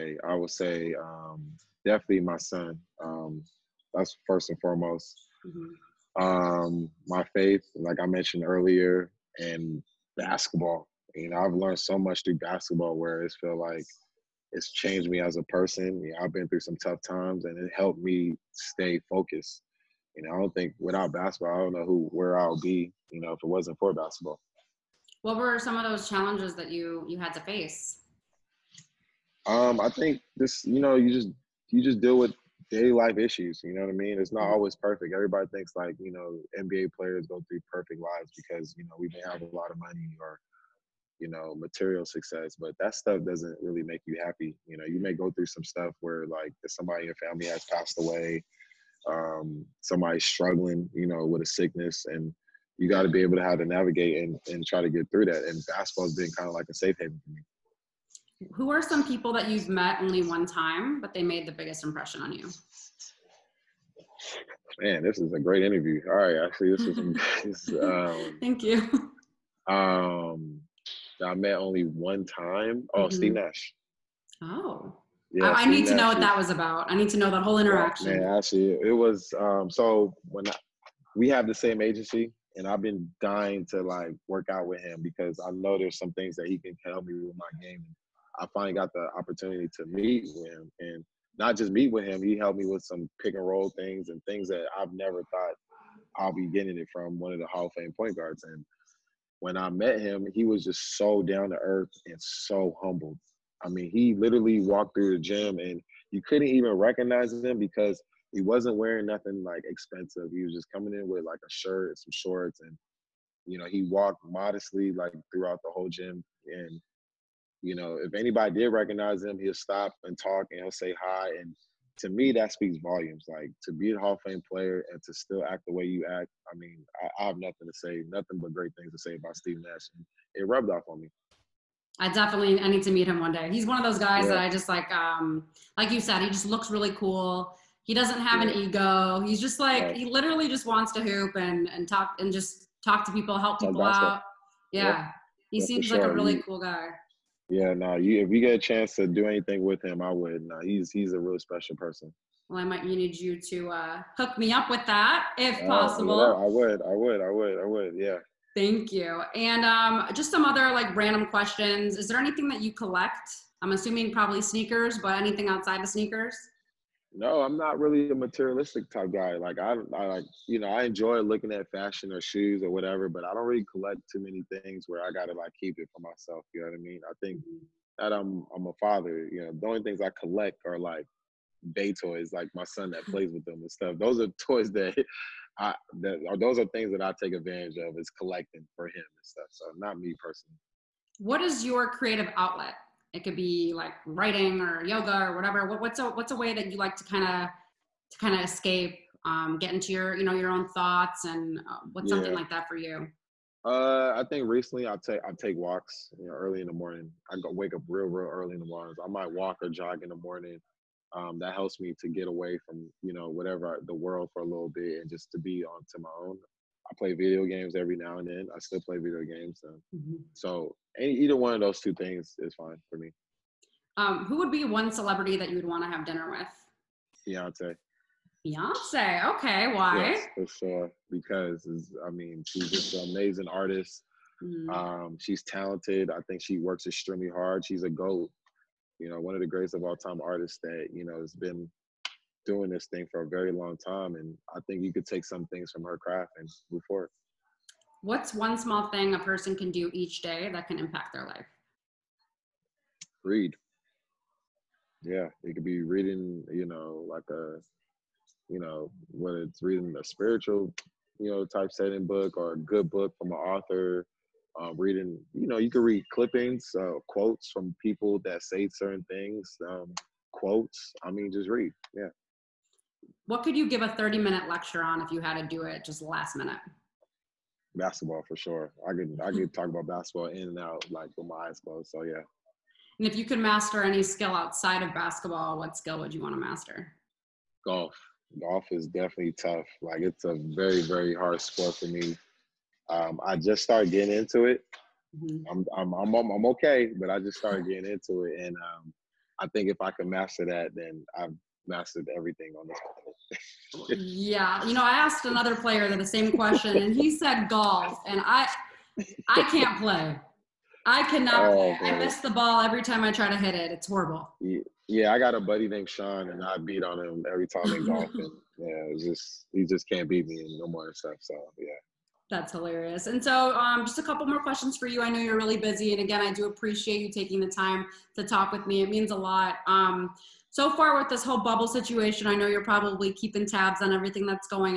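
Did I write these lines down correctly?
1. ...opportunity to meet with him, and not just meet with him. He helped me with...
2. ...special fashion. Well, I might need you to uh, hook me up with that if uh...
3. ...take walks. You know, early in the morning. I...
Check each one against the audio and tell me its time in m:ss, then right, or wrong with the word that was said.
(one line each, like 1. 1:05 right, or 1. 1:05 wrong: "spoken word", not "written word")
1. 1:29 right
2. 2:31 wrong: "person", not "fashion"
3. 3:25 right.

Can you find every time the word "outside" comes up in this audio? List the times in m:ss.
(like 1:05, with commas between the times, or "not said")
2:45, 4:44.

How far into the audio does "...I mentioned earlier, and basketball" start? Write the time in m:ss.
0:08.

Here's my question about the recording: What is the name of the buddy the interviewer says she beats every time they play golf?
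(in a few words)
Sean.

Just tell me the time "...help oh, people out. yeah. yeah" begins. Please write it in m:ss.
2:23.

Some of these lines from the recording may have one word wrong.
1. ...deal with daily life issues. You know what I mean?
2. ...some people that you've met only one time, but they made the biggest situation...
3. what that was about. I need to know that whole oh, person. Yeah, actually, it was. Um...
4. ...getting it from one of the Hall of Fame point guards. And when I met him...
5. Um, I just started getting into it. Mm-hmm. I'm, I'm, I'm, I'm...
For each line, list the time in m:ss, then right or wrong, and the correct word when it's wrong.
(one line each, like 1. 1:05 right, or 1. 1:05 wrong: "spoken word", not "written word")
1. 0:32 right
2. 0:58 wrong: "impression", not "situation"
3. 1:16 wrong: "interaction", not "person"
4. 1:36 right
5. 4:52 right.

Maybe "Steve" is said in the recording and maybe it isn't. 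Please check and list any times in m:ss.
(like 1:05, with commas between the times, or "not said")
1:13, 2:09.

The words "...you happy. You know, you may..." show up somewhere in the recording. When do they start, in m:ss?
0:44.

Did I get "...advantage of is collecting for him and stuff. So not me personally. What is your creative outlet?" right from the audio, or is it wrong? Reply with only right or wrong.
right.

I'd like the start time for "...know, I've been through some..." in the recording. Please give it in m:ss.
0:16.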